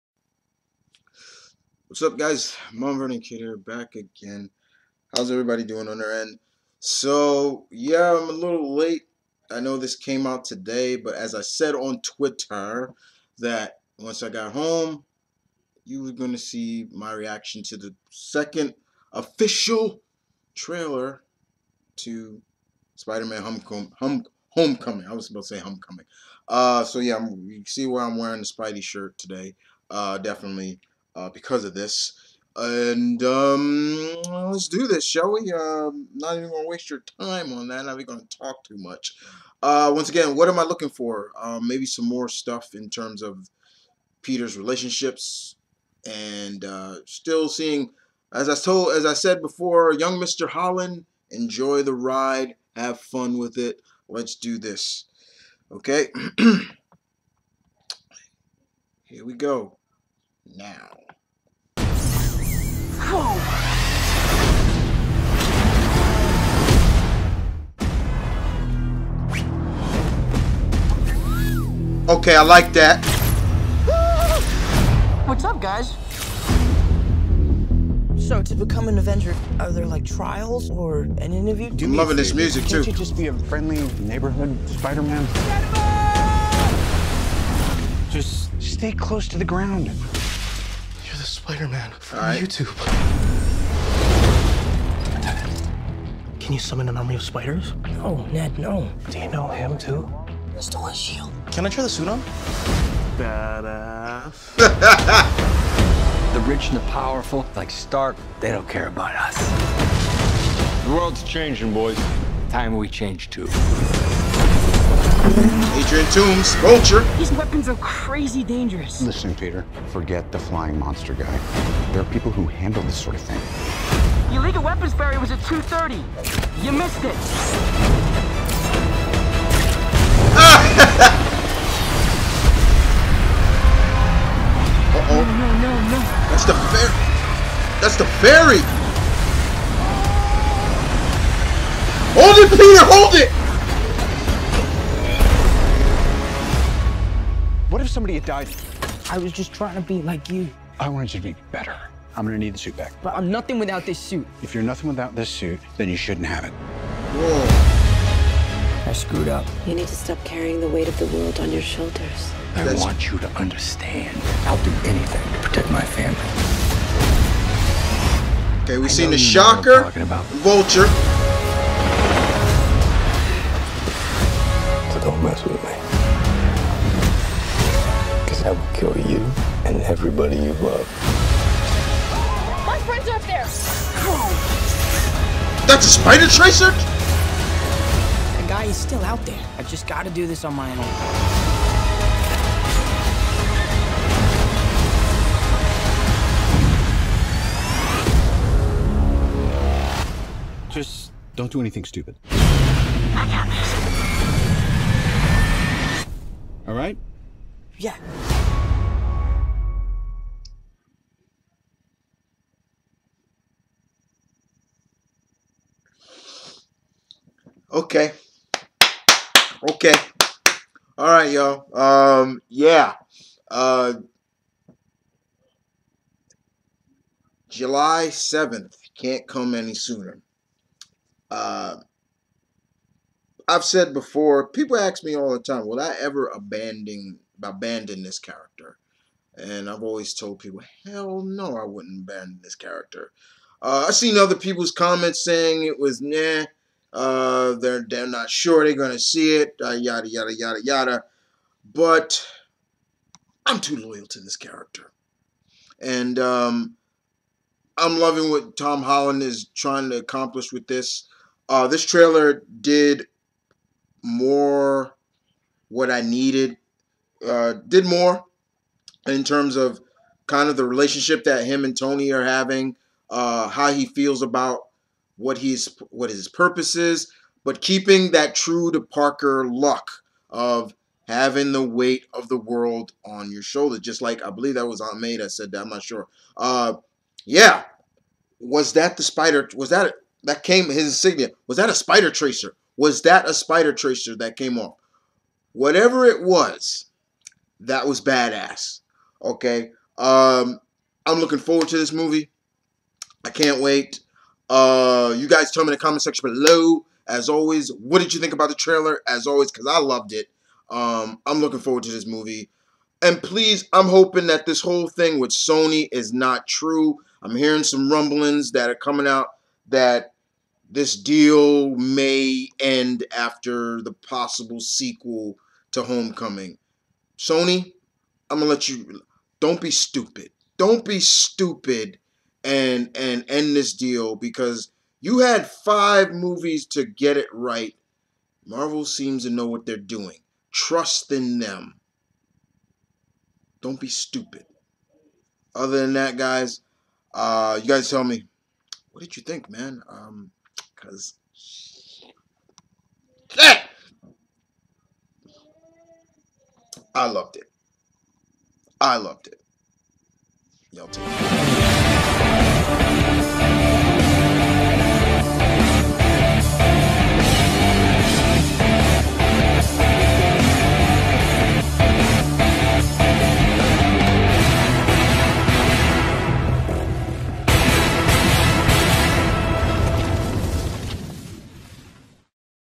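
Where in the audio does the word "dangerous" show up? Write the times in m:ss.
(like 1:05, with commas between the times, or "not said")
1:58.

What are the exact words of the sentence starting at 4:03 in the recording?
Uh, I've seen other people's comments saying it was nah.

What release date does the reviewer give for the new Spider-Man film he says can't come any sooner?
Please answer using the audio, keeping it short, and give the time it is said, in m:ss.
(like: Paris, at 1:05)
July 7th, at 3:47.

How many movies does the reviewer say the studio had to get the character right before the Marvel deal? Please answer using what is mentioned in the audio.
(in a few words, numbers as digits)
5.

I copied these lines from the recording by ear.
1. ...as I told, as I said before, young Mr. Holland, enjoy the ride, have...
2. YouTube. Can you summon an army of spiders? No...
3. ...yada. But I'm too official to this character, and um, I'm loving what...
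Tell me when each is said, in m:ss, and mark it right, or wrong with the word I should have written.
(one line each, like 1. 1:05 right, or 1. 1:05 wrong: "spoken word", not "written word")
1. 0:48 right
2. 1:32 right
3. 4:10 wrong: "loyal", not "official".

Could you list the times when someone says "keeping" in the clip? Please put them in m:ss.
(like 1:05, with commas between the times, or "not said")
4:37.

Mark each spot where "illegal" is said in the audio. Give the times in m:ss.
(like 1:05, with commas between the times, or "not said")
2:04.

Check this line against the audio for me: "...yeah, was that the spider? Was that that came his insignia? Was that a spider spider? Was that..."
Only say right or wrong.
wrong.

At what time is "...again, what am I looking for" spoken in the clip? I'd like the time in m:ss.
0:40.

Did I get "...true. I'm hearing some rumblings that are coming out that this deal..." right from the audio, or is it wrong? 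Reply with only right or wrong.
right.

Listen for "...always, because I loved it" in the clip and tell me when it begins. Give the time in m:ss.
5:09.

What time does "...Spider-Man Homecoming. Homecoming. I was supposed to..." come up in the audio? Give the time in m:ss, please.
0:22.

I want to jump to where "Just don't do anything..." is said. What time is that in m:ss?
3:20.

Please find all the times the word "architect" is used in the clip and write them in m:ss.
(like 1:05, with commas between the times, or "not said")
not said.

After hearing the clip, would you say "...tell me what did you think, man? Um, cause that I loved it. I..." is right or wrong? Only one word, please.
right.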